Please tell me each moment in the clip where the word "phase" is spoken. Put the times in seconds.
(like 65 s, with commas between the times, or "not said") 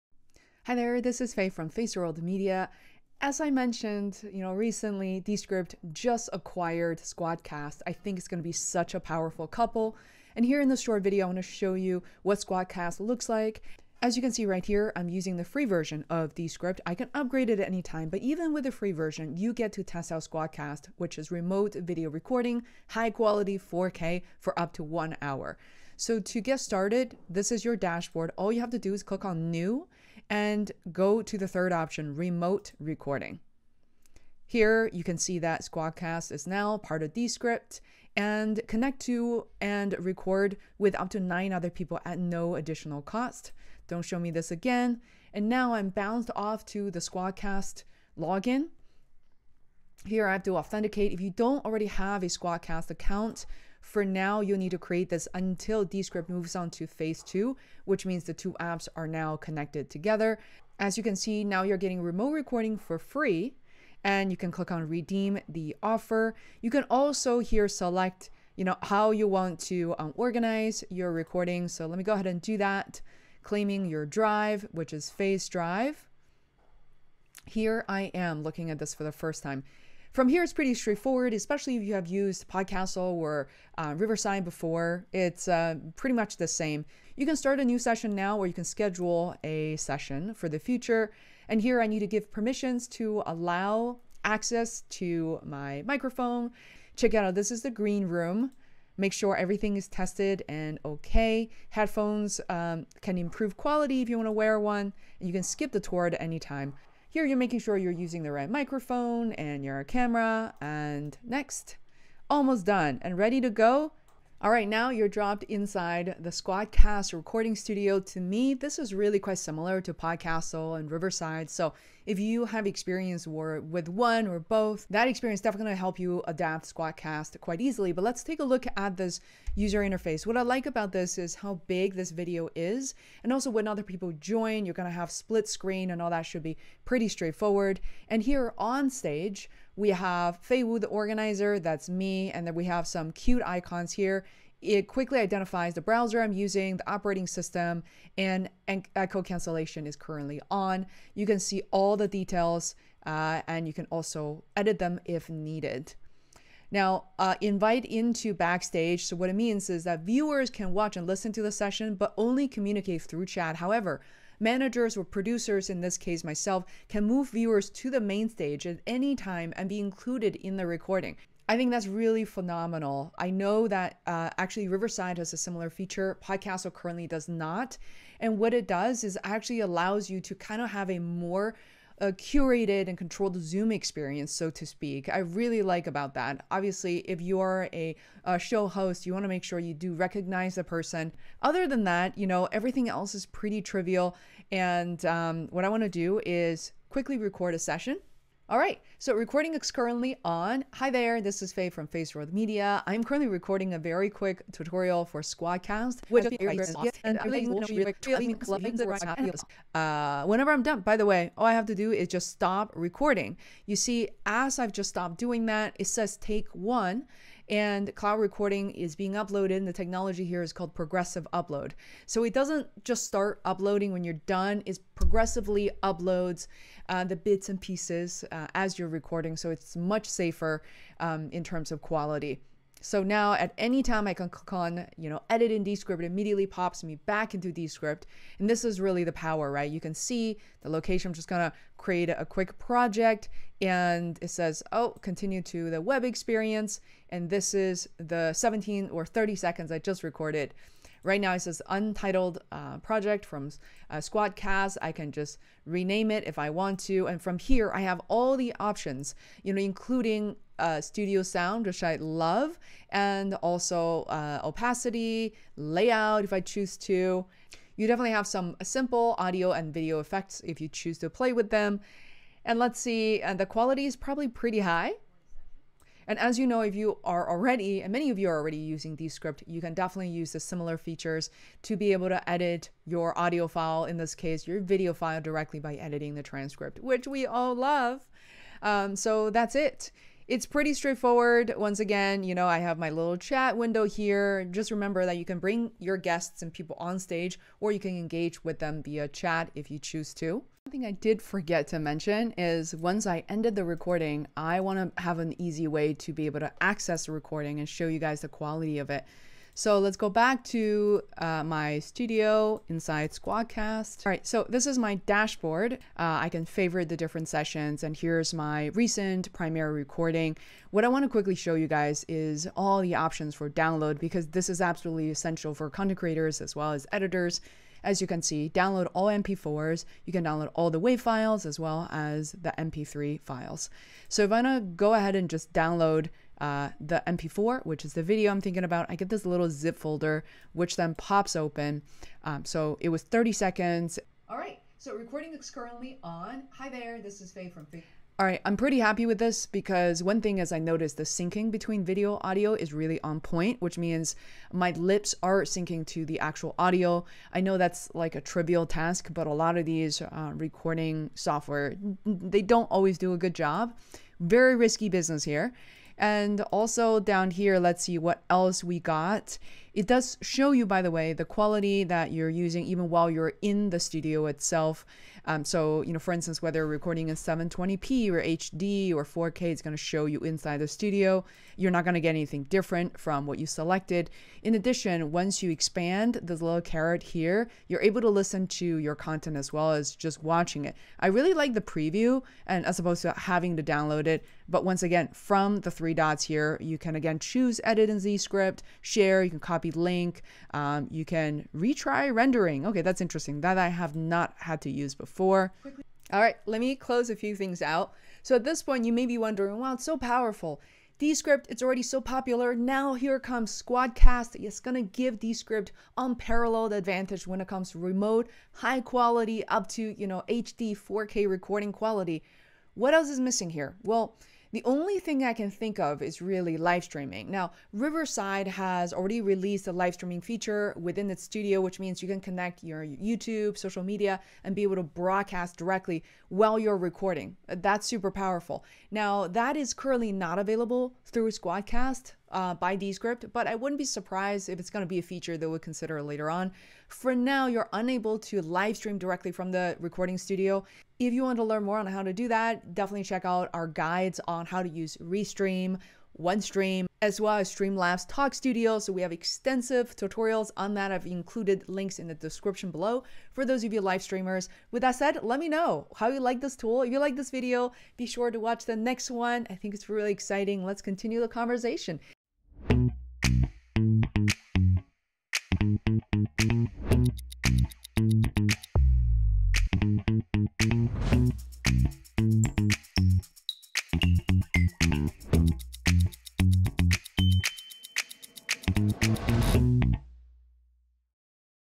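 56 s, 75 s.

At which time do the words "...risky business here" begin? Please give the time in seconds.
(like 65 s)
364 s.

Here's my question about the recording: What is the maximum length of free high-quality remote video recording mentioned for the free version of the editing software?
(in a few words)
1 hour.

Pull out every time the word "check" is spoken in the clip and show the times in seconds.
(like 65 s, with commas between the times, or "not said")
96 s, 453 s.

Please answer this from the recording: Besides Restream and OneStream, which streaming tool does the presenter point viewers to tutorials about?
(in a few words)
Streamlabs Talk Studio.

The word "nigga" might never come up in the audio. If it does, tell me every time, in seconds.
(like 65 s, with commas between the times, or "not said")
not said.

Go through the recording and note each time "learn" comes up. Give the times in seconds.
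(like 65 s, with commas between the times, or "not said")
451 s.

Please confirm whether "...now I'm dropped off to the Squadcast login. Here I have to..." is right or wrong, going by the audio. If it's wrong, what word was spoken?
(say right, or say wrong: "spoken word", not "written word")
wrong: "bounced", not "dropped".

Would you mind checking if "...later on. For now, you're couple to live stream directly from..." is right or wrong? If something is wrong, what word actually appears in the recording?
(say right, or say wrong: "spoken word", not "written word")
wrong: "unable", not "couple".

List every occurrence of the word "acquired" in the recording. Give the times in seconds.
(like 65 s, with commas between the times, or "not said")
6 s.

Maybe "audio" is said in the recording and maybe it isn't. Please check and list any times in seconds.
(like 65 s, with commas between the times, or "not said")
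269 s, 283 s, 352 s, 356 s.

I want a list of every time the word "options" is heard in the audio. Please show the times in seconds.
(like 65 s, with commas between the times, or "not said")
31 s, 258 s, 322 s.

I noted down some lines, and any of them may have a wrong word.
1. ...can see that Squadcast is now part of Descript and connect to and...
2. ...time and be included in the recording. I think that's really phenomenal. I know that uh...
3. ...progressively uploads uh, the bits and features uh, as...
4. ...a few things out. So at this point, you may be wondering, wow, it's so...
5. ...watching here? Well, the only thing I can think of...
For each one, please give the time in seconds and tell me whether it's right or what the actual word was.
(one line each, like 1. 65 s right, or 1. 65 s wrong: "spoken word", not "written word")
1. 35 s right
2. 169 s right
3. 224 s wrong: "pieces", not "features"
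4. 407 s right
5. 423 s wrong: "missing", not "watching".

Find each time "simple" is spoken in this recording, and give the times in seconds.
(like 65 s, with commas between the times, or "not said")
268 s.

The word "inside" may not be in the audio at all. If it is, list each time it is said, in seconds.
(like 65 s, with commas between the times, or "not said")
115 s, 312 s, 380 s.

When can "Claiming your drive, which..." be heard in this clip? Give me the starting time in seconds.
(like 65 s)
73 s.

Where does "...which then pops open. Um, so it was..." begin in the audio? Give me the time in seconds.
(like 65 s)
340 s.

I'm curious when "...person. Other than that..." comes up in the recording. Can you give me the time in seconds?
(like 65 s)
190 s.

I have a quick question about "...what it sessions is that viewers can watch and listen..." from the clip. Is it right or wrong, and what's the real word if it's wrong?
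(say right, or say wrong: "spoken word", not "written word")
wrong: "means", not "sessions".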